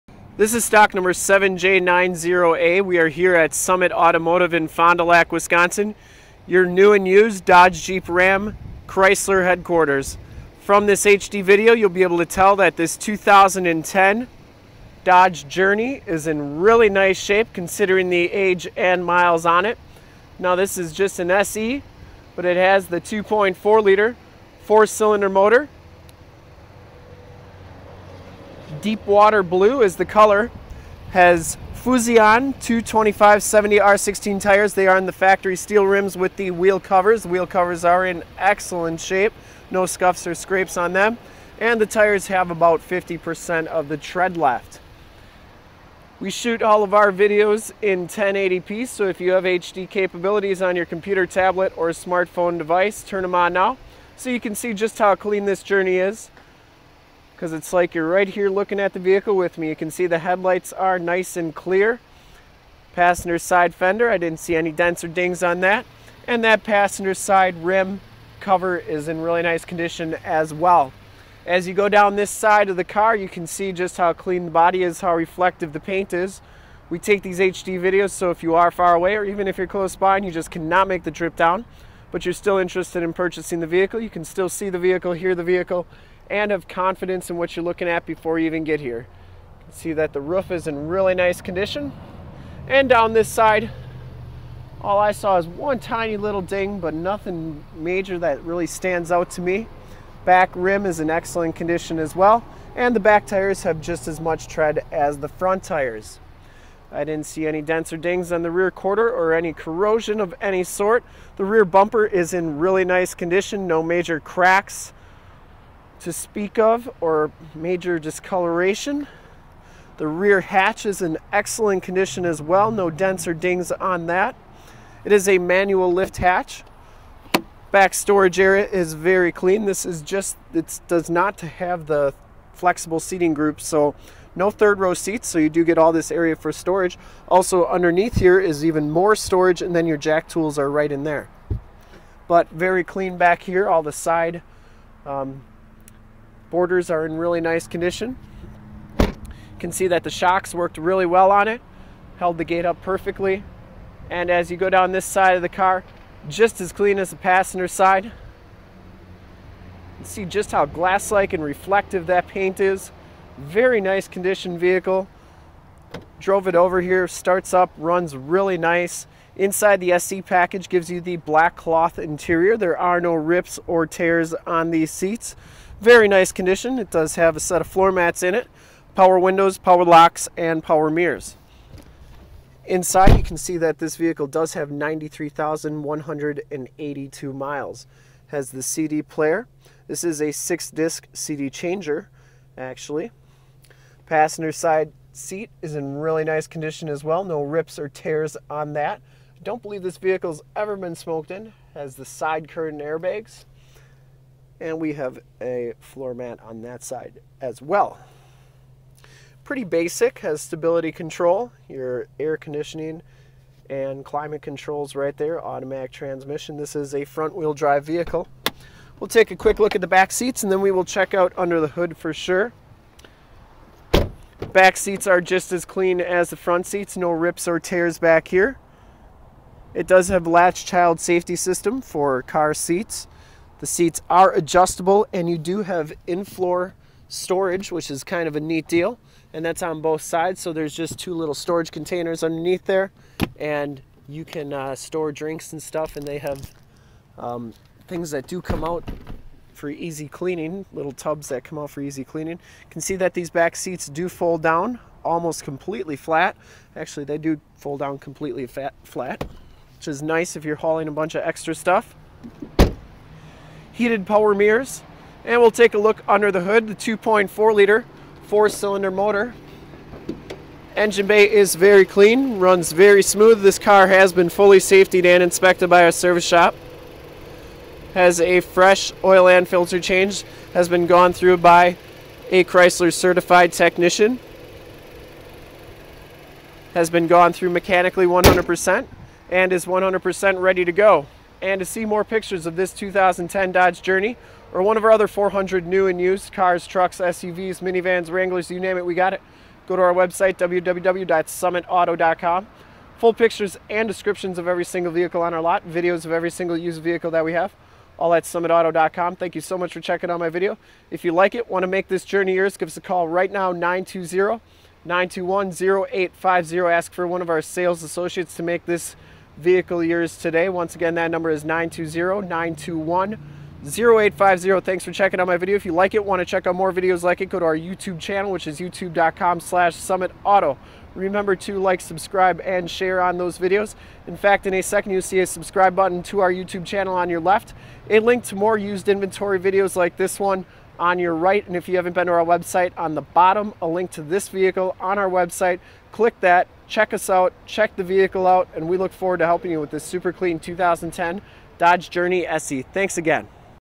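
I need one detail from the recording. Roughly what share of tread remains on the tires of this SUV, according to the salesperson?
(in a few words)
50%.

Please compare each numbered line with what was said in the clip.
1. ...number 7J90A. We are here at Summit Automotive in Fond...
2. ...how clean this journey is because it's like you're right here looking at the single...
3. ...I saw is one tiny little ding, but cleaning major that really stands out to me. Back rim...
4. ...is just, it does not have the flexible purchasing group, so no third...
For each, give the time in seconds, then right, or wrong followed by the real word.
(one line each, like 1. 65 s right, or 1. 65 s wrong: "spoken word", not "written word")
1. 0 s right
2. 54 s wrong: "vehicle", not "single"
3. 94 s wrong: "nothing", not "cleaning"
4. 129 s wrong: "seating", not "purchasing".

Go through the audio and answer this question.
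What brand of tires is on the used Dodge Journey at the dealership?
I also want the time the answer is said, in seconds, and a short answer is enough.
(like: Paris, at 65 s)
Fuzion, at 31 s.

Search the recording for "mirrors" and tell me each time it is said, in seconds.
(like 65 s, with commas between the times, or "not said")
180 s, 264 s.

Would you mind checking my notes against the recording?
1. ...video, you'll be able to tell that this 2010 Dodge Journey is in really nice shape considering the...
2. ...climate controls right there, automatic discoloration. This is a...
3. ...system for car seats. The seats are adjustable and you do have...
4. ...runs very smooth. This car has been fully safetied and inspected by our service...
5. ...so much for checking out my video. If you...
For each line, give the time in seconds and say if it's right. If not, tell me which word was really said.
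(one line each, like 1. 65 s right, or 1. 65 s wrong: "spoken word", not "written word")
1. 11 s right
2. 214 s wrong: "transmission", not "discoloration"
3. 231 s right
4. 272 s right
5. 309 s right.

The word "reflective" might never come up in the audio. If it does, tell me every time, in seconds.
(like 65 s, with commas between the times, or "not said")
75 s, 161 s.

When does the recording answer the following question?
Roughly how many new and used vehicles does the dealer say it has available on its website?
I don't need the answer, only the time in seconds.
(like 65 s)
295 s.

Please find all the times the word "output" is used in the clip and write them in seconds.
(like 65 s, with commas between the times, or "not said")
not said.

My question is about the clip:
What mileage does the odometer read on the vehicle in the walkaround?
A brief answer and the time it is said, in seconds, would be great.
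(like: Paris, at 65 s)
93,182 miles, at 184 s.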